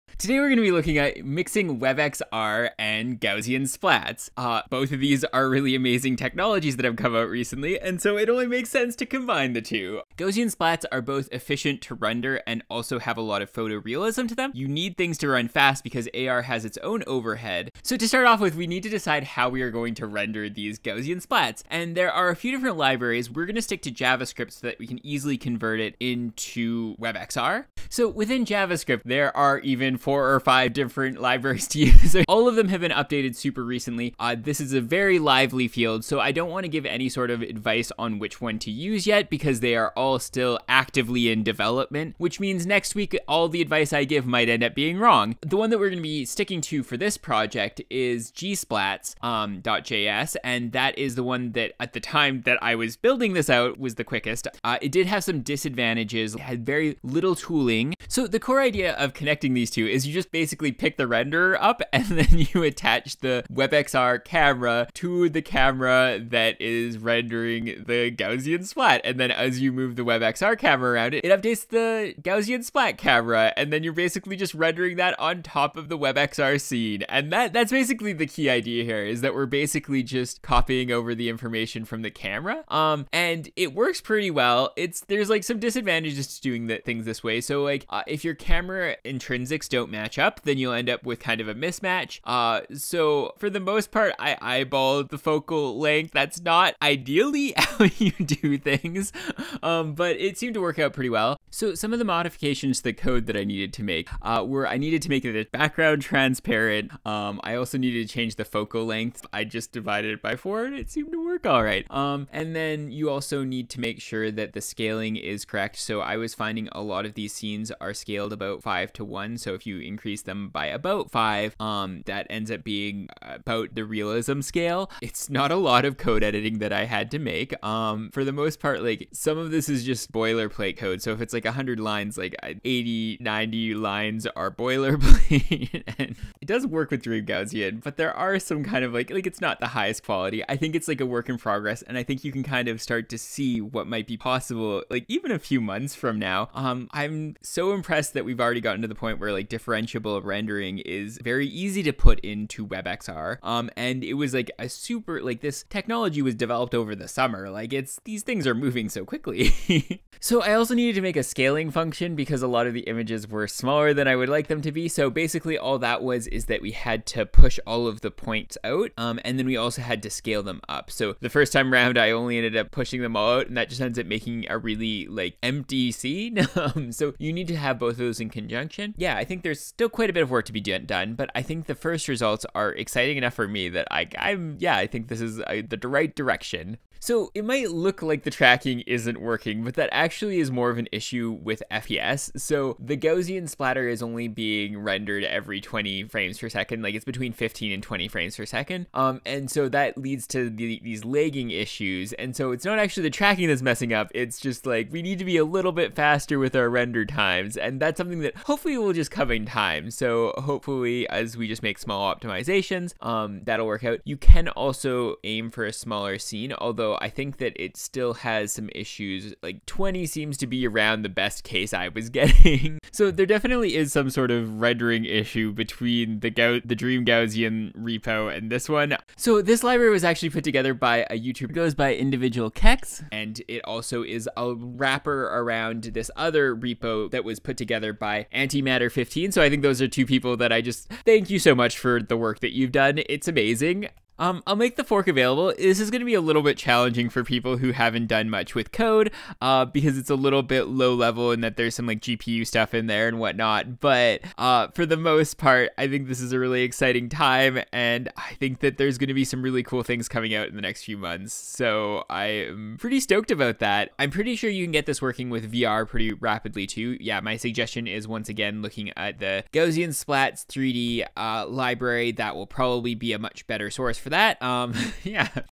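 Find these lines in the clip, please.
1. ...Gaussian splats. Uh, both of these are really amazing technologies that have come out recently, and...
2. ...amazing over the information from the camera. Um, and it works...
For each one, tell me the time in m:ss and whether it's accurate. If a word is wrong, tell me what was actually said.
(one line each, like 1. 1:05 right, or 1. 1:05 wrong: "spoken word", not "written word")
1. 0:03 right
2. 1:20 wrong: "copying", not "amazing".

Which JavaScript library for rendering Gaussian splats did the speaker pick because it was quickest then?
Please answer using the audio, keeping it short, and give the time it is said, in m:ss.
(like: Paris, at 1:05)
gsplats.js, at 0:48.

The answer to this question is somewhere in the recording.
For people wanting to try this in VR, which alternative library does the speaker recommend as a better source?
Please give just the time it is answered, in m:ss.
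4:29.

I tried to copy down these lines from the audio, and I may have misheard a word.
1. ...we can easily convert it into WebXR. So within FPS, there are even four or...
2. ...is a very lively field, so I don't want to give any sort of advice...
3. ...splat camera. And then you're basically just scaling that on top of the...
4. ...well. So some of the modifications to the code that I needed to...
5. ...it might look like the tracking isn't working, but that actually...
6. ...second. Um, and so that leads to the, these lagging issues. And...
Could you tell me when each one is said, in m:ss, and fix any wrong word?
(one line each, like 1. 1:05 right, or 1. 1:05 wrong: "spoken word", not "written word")
1. 0:24 wrong: "JavaScript", not "FPS"
2. 0:34 right
3. 1:12 wrong: "rendering", not "scaling"
4. 1:41 right
5. 3:07 right
6. 3:18 right.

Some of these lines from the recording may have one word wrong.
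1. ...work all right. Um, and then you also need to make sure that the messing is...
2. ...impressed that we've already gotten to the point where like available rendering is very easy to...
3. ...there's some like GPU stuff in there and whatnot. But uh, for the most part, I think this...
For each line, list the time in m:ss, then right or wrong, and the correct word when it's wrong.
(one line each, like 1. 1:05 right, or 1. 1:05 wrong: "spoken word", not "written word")
1. 1:51 wrong: "scaling", not "messing"
2. 2:27 wrong: "differentiable", not "available"
3. 4:11 right.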